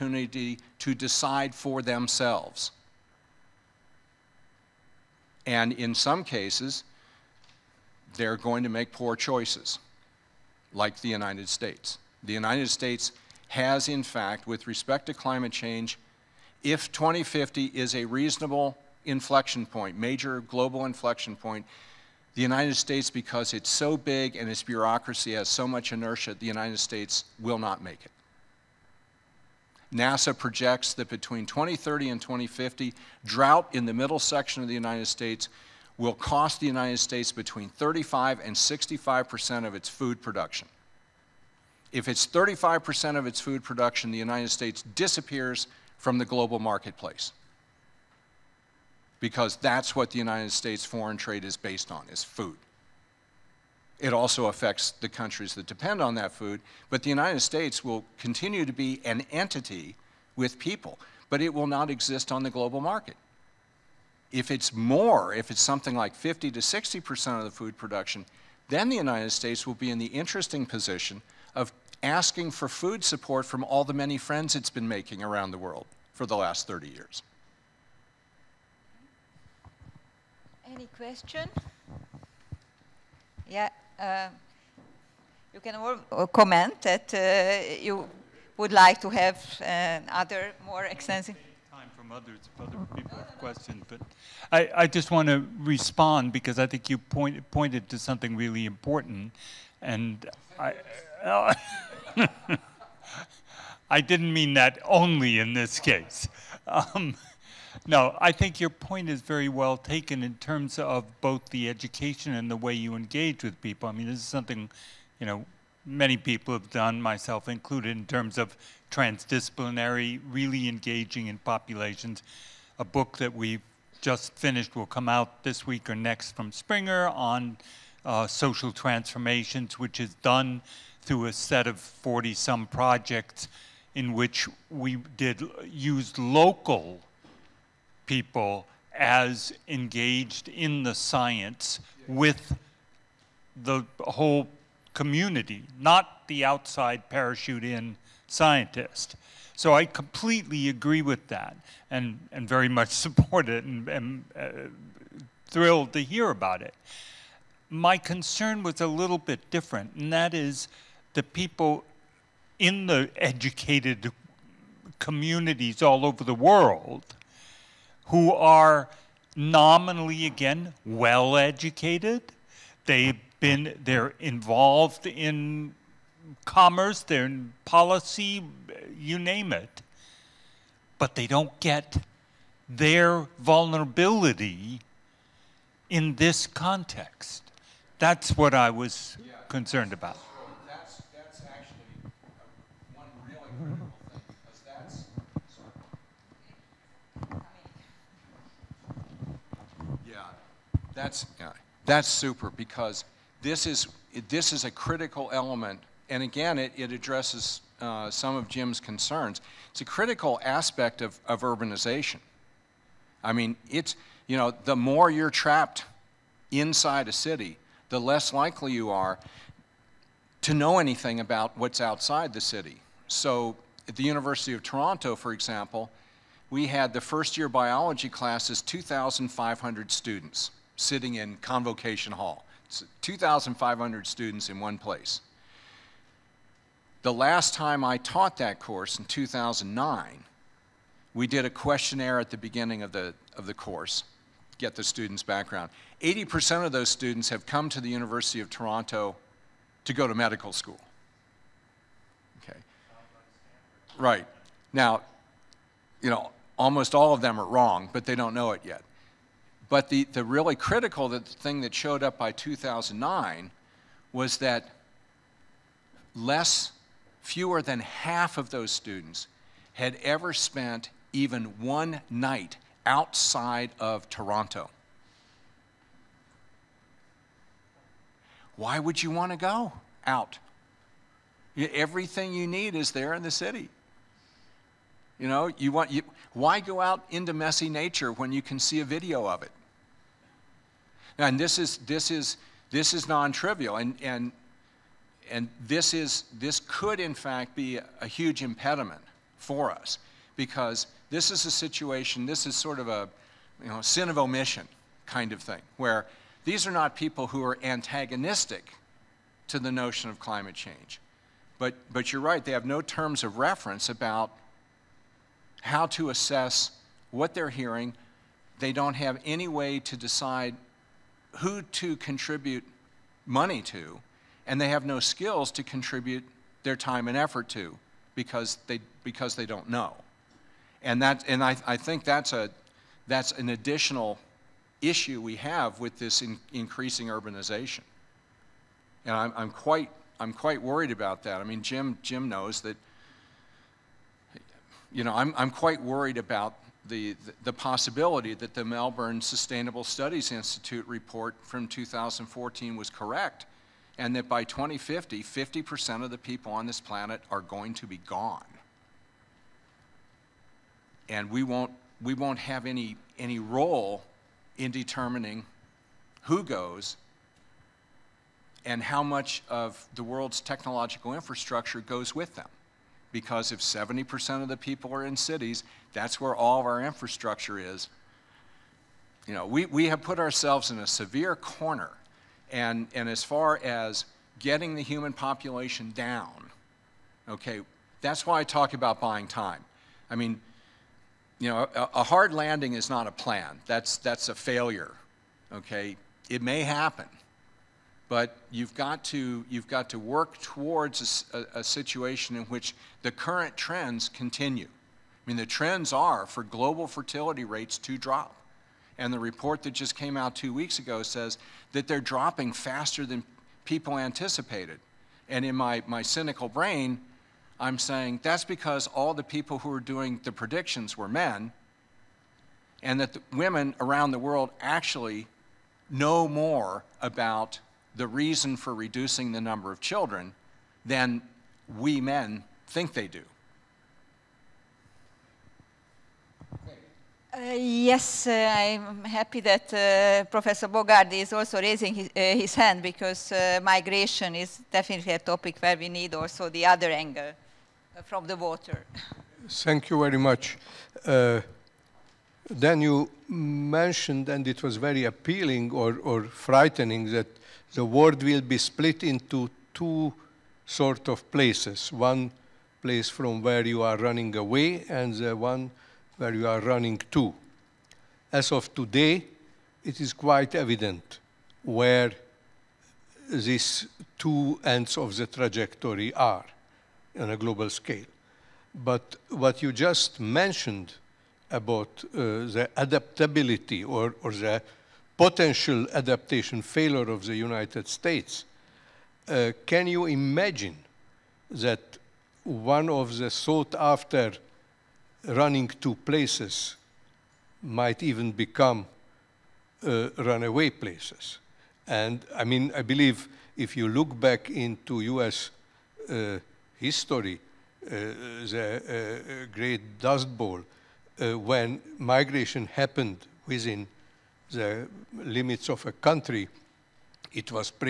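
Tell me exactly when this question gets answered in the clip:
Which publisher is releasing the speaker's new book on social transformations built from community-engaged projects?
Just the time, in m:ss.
2:06.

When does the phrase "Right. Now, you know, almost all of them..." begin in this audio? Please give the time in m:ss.
4:13.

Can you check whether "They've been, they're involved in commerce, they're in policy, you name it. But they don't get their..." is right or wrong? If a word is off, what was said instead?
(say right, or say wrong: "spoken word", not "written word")
right.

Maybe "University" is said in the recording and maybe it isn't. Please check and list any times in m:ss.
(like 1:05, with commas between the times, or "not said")
3:44, 4:07.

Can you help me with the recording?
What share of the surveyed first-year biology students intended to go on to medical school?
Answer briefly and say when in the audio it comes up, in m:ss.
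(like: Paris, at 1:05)
80%, at 4:06.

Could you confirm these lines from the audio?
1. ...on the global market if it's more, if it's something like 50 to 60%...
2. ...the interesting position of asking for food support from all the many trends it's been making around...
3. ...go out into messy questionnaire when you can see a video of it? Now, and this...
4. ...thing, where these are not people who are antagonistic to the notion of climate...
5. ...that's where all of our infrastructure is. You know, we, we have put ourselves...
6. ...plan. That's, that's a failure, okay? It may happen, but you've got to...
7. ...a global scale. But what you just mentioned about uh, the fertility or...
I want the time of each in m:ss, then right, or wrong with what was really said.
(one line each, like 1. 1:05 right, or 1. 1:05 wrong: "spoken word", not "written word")
1. 1:02 right
2. 1:09 wrong: "friends", not "trends"
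3. 4:46 wrong: "nature", not "questionnaire"
4. 5:05 right
5. 6:15 right
6. 6:33 right
7. 7:57 wrong: "adaptability", not "fertility".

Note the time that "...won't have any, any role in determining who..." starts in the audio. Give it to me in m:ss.
6:02.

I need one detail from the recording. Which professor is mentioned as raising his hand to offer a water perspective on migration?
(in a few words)
Professor Bogardi.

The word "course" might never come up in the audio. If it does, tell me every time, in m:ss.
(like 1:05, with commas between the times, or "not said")
3:58, 4:03.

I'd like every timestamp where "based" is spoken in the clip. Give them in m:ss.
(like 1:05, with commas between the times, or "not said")
0:51.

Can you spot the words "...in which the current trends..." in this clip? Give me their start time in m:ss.
6:42.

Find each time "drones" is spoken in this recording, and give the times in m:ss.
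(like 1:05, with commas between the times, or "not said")
not said.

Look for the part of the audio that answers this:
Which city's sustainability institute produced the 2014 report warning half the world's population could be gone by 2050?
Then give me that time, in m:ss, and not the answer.
5:48.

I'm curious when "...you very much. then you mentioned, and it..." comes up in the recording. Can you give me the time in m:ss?
7:29.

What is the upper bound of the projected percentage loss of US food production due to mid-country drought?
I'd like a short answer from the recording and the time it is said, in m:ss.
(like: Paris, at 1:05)
65%, at 0:38.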